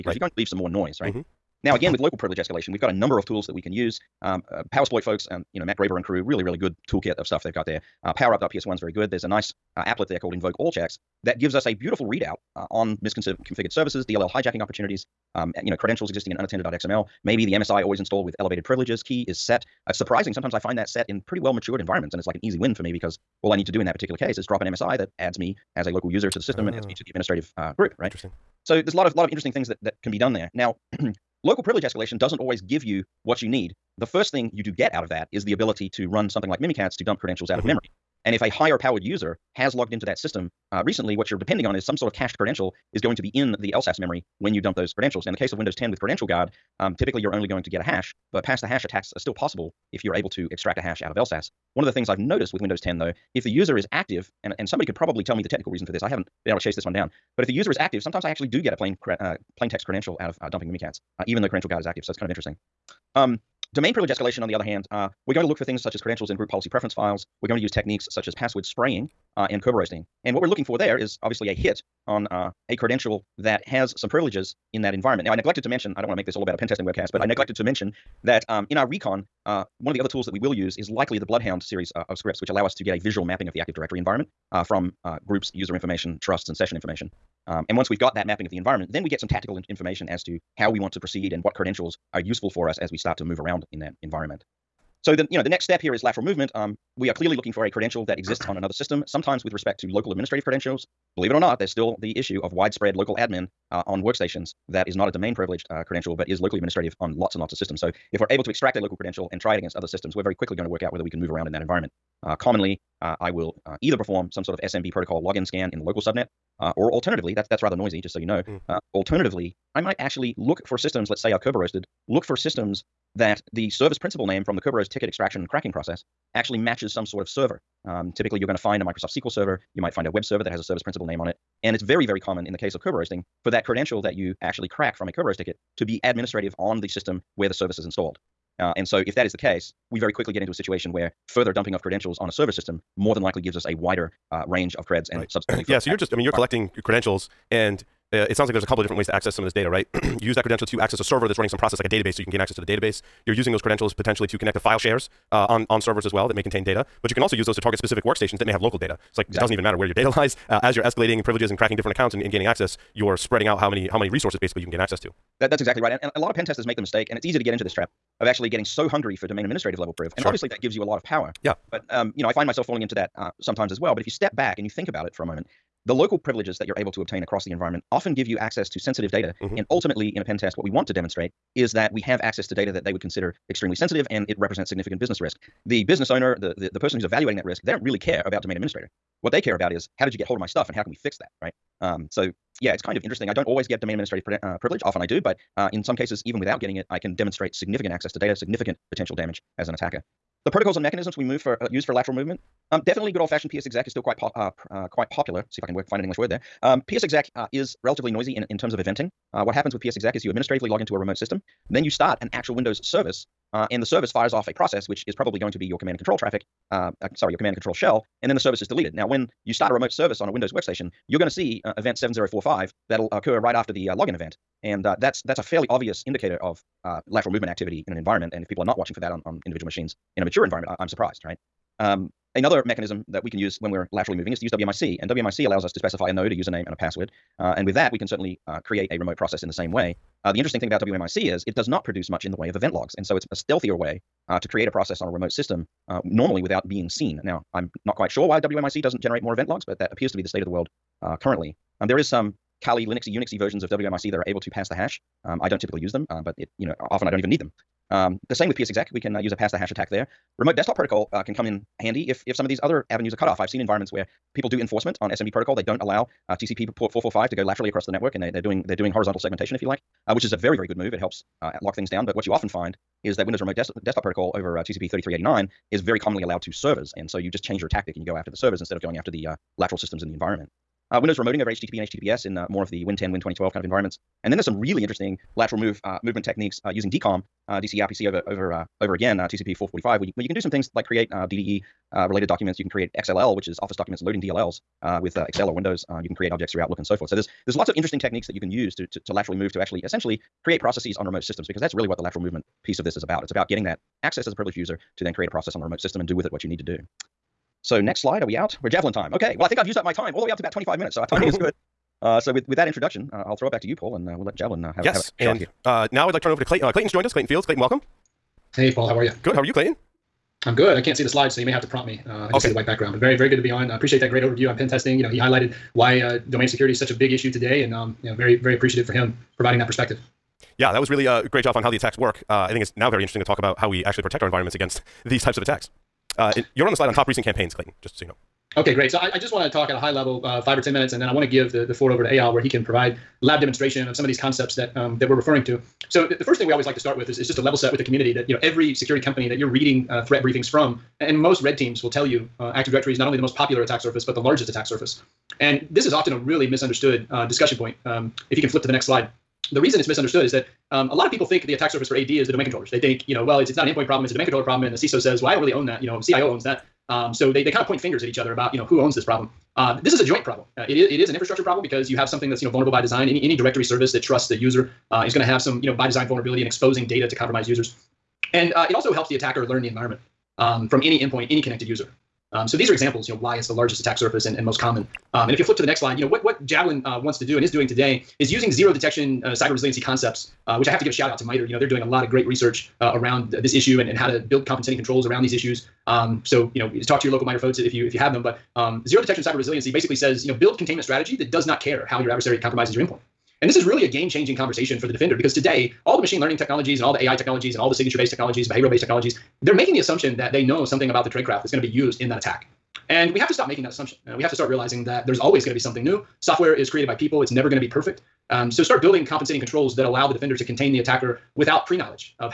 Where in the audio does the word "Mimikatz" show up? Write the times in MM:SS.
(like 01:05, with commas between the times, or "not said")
00:36, 01:00.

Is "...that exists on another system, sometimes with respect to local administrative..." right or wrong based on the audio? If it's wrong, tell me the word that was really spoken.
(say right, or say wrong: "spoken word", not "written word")
right.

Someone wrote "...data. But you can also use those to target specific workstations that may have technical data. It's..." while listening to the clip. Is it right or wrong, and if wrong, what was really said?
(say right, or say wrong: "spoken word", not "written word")
wrong: "local", not "technical".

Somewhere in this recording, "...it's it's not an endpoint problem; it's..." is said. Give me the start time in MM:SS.
06:03.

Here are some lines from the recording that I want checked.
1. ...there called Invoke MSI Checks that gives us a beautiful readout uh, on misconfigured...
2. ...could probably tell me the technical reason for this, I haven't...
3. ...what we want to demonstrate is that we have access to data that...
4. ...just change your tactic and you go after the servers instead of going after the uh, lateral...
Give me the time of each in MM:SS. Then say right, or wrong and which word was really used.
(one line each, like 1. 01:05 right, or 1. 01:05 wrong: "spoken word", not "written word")
1. 00:10 wrong: "All", not "MSI"
2. 00:54 right
3. 03:00 right
4. 04:37 right.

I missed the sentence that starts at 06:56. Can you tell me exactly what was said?
Software is created by people, it's never going to be perfect.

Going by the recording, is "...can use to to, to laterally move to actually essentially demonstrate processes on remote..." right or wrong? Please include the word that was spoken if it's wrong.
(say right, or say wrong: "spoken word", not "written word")
wrong: "create", not "demonstrate".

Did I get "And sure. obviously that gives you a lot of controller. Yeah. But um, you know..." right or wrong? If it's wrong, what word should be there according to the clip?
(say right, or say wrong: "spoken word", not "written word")
wrong: "power", not "controller".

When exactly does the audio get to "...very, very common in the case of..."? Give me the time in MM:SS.
02:11.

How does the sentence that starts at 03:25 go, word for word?
Let's see if I can work find an English word there.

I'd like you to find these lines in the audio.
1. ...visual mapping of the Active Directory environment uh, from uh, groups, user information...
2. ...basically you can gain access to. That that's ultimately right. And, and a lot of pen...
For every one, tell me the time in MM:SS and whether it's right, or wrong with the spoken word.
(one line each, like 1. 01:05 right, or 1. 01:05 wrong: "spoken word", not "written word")
1. 01:22 right
2. 02:44 wrong: "exactly", not "ultimately".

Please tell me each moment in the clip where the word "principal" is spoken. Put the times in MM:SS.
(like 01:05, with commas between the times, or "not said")
02:03, 02:10.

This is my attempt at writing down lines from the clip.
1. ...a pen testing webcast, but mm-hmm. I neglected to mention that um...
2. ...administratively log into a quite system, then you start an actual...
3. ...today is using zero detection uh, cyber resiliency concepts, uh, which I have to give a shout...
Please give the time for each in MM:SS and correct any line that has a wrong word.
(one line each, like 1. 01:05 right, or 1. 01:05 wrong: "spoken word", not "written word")
1. 01:16 right
2. 03:30 wrong: "remote", not "quite"
3. 06:27 right.